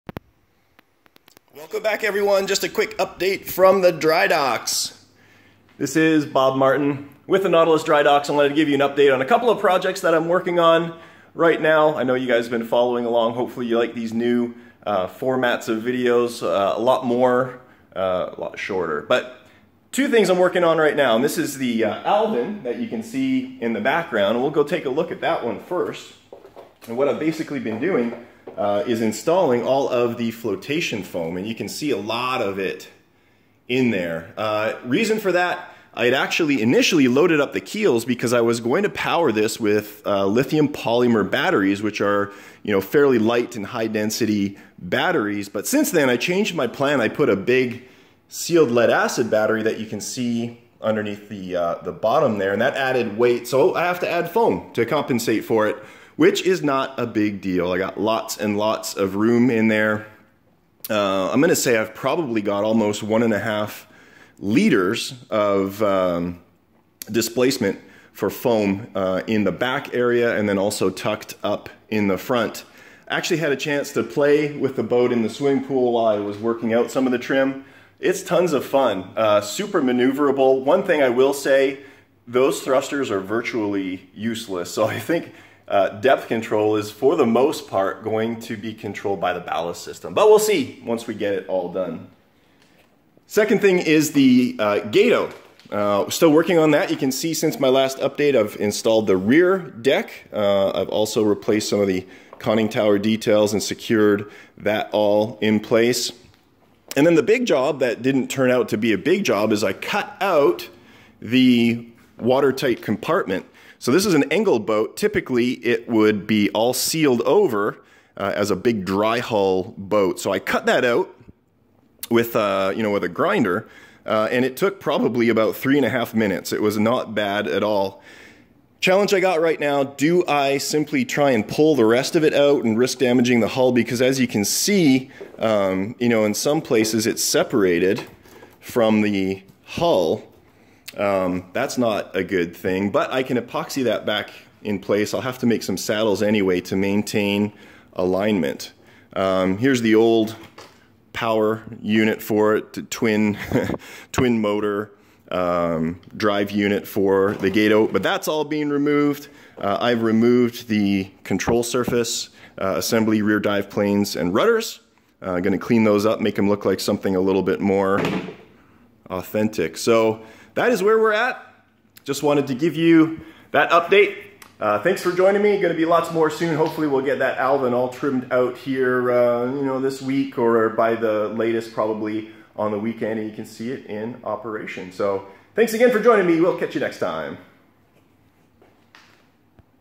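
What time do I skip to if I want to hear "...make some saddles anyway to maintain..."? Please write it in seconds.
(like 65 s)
145 s.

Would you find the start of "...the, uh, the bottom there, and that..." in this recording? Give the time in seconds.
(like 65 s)
51 s.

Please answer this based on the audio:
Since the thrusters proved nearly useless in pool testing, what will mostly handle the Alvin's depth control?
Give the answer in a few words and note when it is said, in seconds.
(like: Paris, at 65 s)
Ballast system, at 89 s.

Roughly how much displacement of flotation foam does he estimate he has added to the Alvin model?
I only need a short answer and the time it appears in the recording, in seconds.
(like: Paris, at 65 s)
1.5 liters, at 63 s.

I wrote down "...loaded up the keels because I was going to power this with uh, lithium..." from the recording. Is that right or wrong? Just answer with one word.
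right.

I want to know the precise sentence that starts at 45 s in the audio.
But since then, I changed my plan.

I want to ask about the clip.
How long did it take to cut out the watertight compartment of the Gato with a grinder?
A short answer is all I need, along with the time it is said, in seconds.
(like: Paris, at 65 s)
About 3.5 minutes, at 125 s.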